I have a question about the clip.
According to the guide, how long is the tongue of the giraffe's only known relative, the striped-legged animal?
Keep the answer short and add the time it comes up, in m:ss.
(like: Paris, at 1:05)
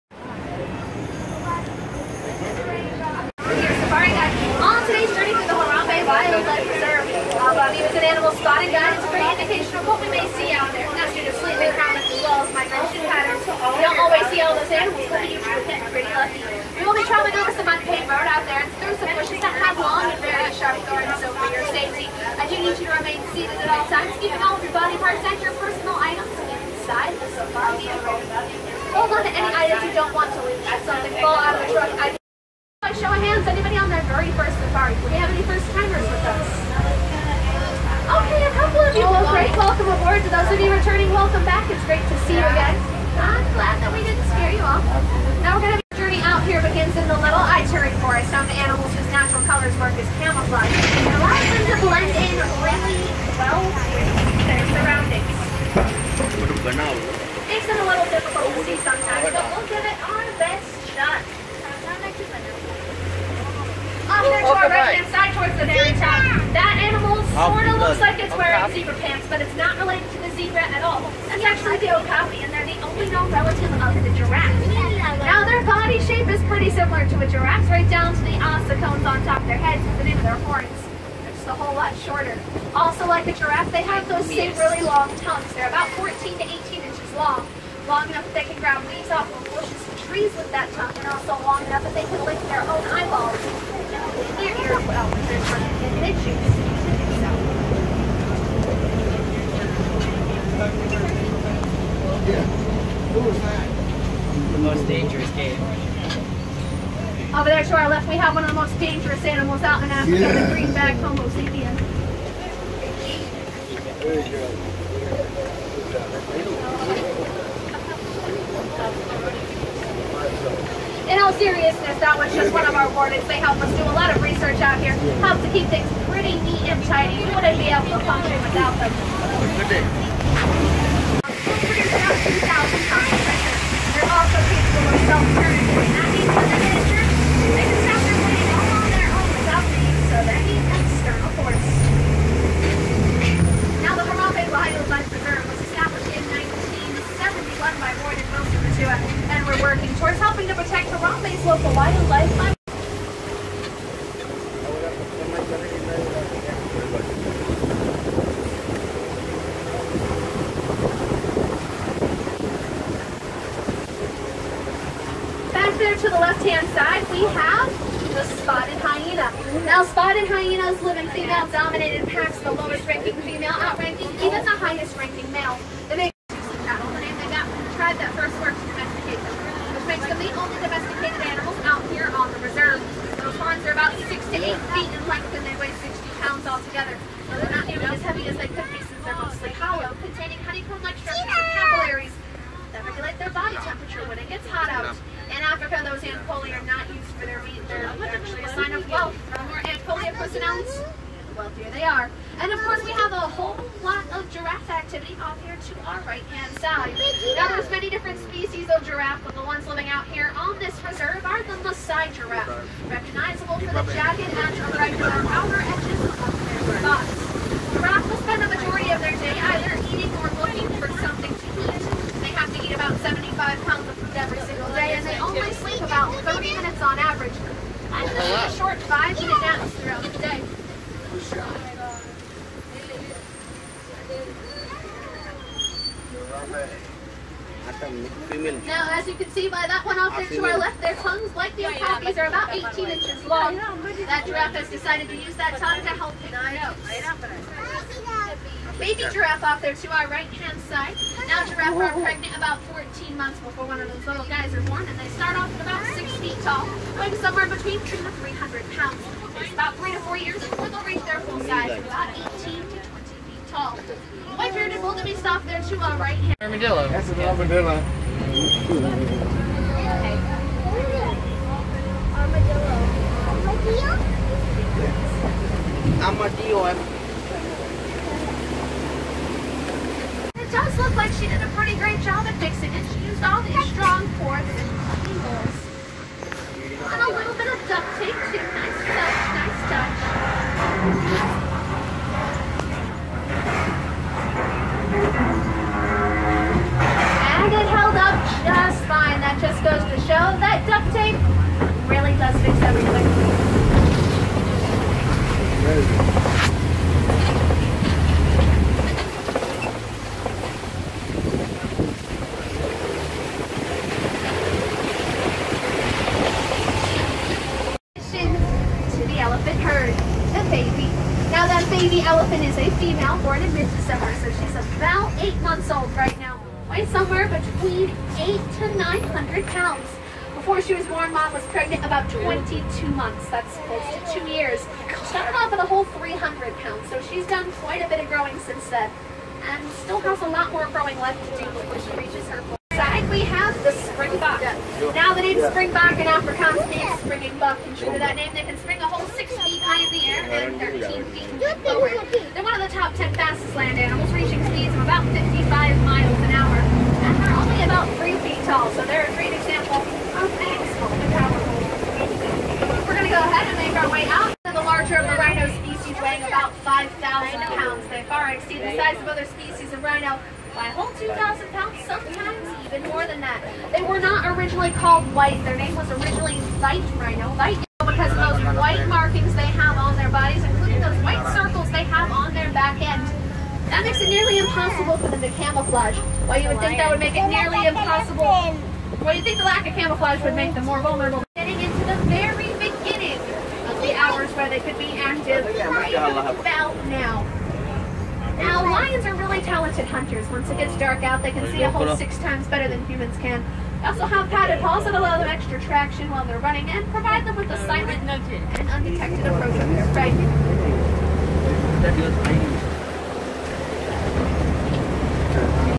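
14 to 18 inches, at 1:25.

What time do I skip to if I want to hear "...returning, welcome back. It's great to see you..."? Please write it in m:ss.
0:40.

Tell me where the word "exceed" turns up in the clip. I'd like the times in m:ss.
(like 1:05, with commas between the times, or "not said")
6:08.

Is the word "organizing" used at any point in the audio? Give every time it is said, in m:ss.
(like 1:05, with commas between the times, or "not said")
not said.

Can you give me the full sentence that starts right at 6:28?
Well, you think the lack of camouflage would make them more vulnerable.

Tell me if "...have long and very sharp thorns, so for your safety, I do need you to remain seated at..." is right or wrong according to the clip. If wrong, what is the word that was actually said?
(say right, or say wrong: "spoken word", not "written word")
right.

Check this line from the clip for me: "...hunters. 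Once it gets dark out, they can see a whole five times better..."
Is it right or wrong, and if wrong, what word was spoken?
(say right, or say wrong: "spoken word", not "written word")
wrong: "six", not "five".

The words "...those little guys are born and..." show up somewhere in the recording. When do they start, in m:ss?
4:13.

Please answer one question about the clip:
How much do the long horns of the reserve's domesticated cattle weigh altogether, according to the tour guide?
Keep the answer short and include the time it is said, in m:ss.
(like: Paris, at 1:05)
60 pounds, at 3:05.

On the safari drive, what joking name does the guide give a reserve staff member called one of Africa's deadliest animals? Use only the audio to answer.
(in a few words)
green-bagged homo sapiens.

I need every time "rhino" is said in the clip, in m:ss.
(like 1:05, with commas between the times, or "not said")
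6:05, 6:09, 6:16.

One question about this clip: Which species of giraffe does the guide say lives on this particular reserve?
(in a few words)
Maasai giraffe.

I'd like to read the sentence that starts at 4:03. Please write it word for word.
That giraffe has decided to use that tongue to help deny baby giraffe off there to our right hand side.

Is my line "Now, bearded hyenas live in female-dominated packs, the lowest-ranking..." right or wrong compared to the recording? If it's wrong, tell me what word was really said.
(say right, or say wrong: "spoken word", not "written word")
wrong: "spotted", not "bearded".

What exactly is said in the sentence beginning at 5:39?
And still has a lot more growing left to do before she reaches her full size.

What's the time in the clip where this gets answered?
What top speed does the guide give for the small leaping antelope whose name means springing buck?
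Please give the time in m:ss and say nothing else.
5:55.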